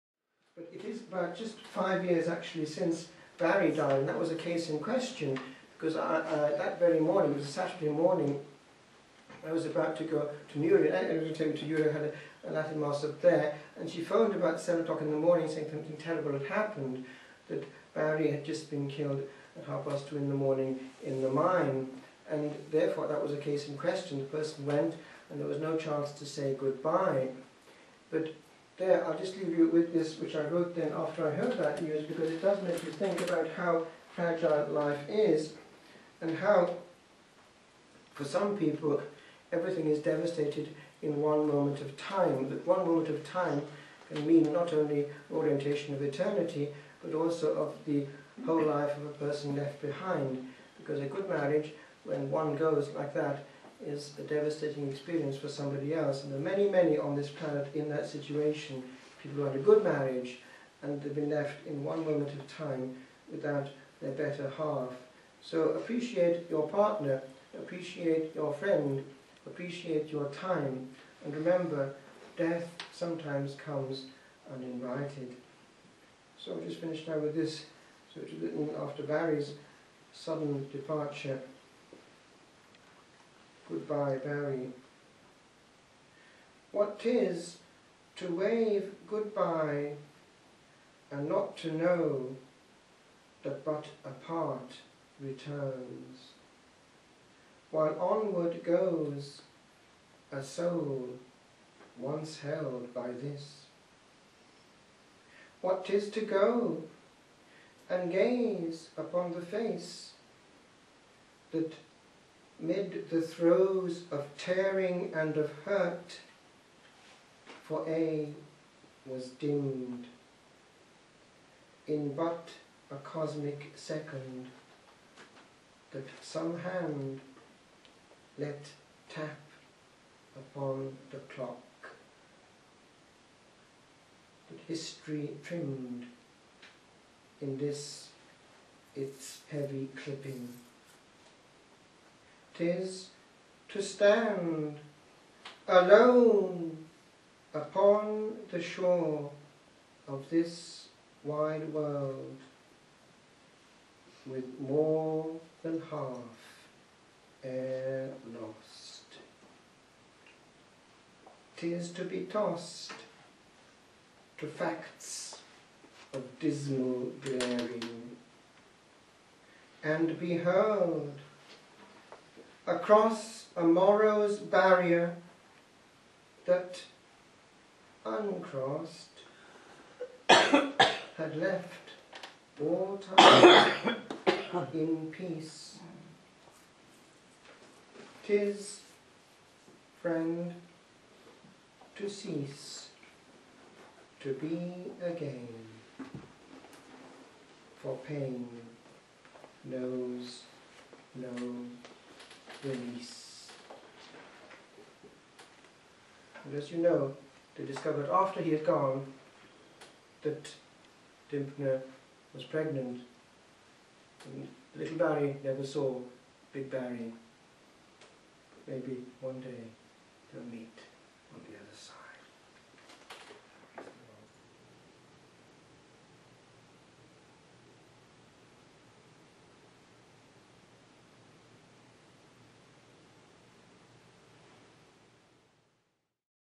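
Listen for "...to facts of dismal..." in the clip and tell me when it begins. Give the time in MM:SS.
02:44.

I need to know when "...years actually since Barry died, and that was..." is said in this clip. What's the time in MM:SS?
00:02.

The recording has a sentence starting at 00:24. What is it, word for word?
The person went, and there was no chance to say goodbye.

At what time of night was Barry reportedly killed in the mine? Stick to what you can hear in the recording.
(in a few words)
2:30 am.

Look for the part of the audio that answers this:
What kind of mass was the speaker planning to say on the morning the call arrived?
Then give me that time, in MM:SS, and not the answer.
00:12.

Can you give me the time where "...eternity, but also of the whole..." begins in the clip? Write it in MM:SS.
00:46.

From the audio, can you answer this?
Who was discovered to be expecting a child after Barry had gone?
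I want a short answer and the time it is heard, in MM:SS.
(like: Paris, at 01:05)
Dymphna, at 03:31.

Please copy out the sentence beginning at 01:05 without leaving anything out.
So appreciate your partner, appreciate your friend, appreciate your time, and remember, death sometimes comes uninvited.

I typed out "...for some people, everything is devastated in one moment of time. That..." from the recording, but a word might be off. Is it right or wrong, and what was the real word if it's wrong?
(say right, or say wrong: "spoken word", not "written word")
right.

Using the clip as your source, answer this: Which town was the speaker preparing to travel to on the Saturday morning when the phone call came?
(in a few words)
Newry.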